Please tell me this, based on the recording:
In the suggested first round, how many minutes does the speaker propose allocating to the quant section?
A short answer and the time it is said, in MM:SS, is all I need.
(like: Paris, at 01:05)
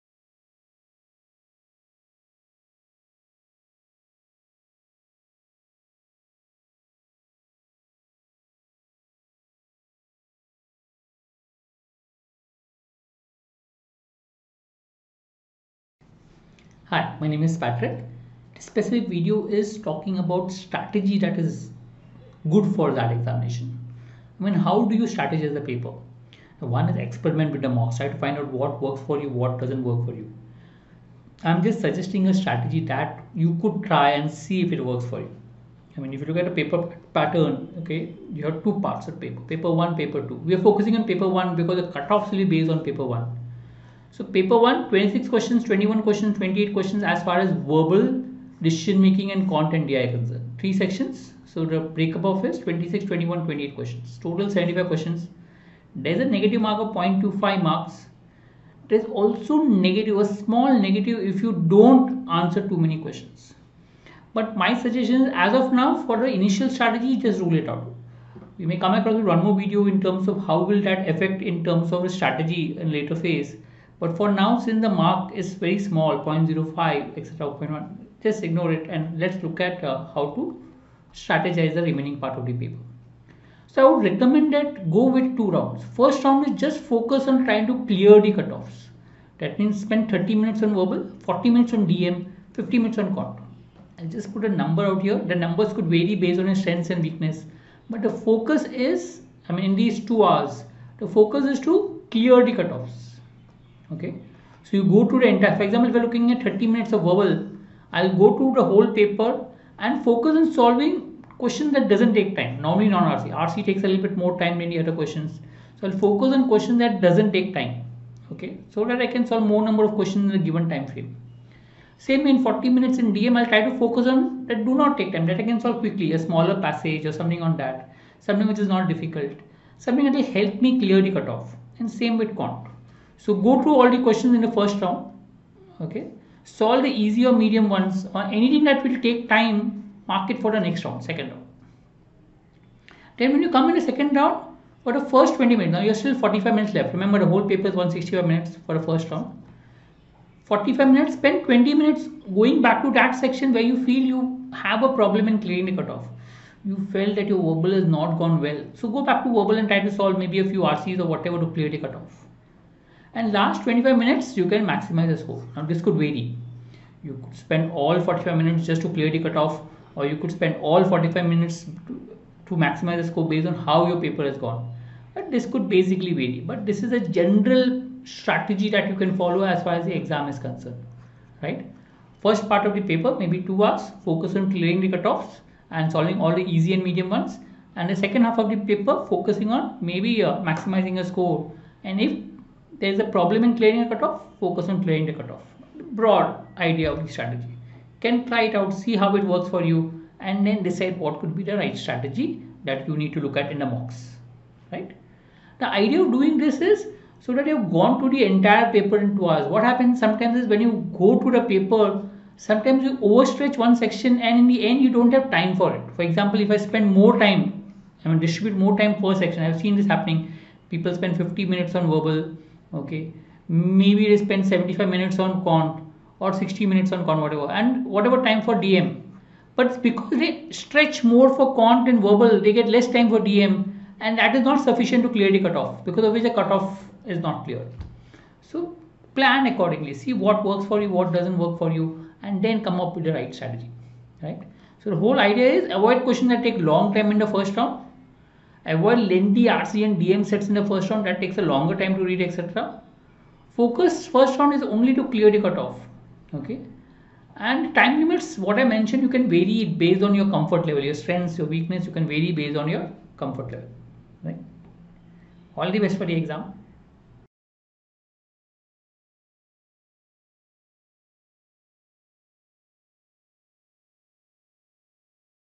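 50 minutes, at 01:32.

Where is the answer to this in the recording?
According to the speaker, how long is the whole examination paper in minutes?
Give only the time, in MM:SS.
02:27.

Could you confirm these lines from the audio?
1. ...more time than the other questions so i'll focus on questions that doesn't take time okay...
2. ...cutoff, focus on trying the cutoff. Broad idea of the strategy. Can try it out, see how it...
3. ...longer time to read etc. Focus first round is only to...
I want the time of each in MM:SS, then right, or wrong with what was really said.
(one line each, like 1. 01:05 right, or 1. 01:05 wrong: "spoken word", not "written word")
1. 01:54 right
2. 03:13 wrong: "clearing", not "trying"
3. 04:11 right.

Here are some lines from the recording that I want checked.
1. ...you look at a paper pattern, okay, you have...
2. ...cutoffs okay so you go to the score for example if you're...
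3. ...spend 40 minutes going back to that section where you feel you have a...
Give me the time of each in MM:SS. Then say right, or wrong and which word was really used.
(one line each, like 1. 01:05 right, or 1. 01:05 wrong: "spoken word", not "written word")
1. 00:36 right
2. 01:42 wrong: "entire", not "score"
3. 02:31 wrong: "20", not "40".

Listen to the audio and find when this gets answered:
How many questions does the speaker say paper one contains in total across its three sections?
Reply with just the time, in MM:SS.
00:54.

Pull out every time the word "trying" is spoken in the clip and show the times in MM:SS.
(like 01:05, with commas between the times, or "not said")
01:27.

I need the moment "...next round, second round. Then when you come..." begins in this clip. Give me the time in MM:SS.
02:20.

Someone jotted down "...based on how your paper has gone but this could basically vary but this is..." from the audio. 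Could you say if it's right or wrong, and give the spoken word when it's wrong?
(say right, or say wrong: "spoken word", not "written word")
right.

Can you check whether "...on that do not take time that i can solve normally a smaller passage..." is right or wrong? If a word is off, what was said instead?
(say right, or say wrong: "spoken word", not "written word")
wrong: "quickly", not "normally".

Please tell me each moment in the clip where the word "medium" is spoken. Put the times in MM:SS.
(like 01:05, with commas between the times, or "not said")
02:17, 03:06.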